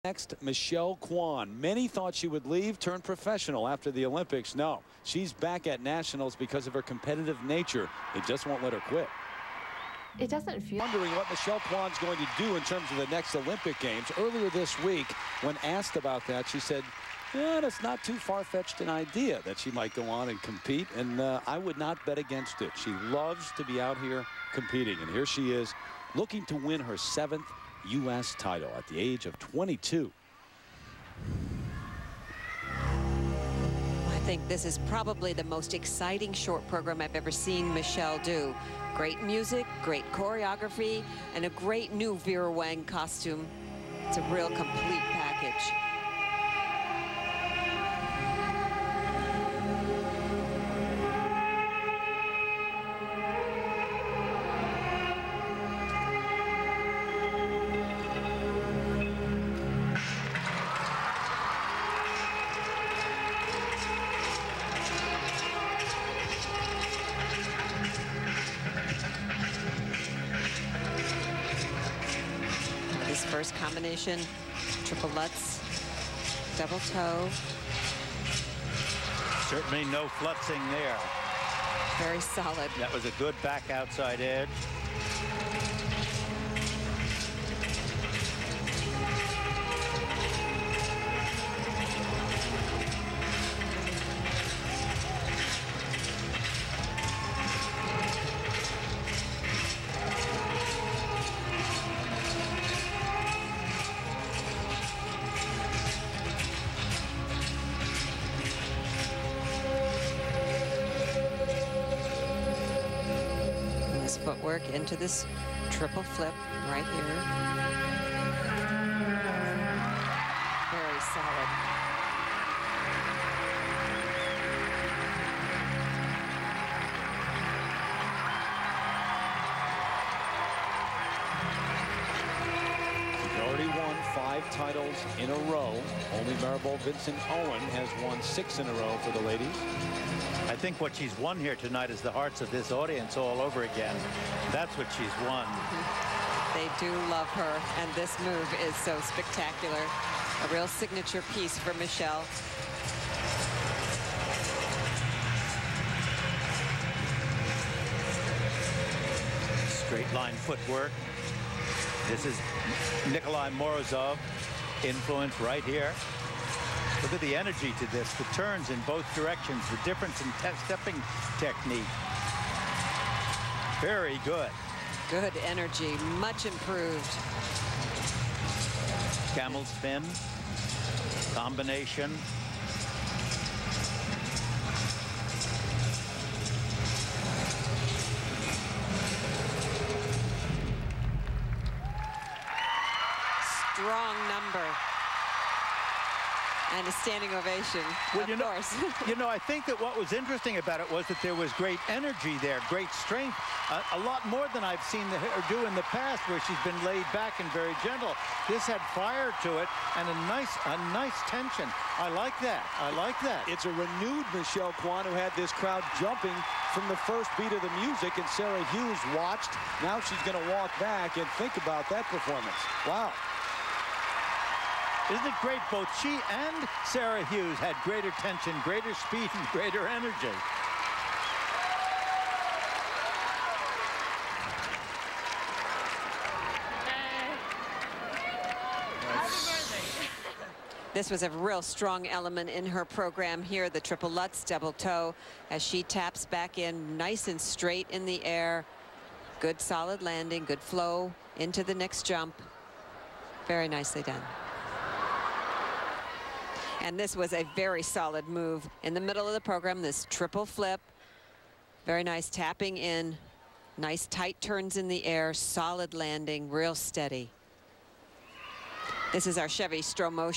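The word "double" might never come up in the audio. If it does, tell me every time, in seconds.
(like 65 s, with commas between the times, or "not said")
76 s, 244 s.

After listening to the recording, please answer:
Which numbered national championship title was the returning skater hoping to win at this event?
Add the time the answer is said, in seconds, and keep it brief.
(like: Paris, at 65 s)
7th, at 26 s.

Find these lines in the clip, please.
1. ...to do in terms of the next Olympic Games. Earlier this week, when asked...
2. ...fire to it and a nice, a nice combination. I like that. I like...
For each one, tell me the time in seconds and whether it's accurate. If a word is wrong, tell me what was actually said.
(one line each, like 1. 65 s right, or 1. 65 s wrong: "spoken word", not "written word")
1. 12 s right
2. 208 s wrong: "tension", not "combination".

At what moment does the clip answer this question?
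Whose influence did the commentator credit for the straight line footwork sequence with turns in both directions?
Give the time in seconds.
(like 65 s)
163 s.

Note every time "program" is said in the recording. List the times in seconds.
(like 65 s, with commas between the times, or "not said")
36 s, 242 s, 259 s.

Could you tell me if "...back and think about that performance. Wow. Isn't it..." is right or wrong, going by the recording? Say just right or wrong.
right.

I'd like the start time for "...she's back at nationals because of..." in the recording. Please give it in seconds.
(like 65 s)
5 s.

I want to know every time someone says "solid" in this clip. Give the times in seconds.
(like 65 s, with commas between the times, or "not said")
82 s, 249 s, 257 s, 265 s.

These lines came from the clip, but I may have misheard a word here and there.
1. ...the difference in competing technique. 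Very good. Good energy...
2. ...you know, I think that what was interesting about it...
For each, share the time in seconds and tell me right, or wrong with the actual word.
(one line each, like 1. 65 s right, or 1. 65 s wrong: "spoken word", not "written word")
1. 169 s wrong: "stepping", not "competing"
2. 199 s right.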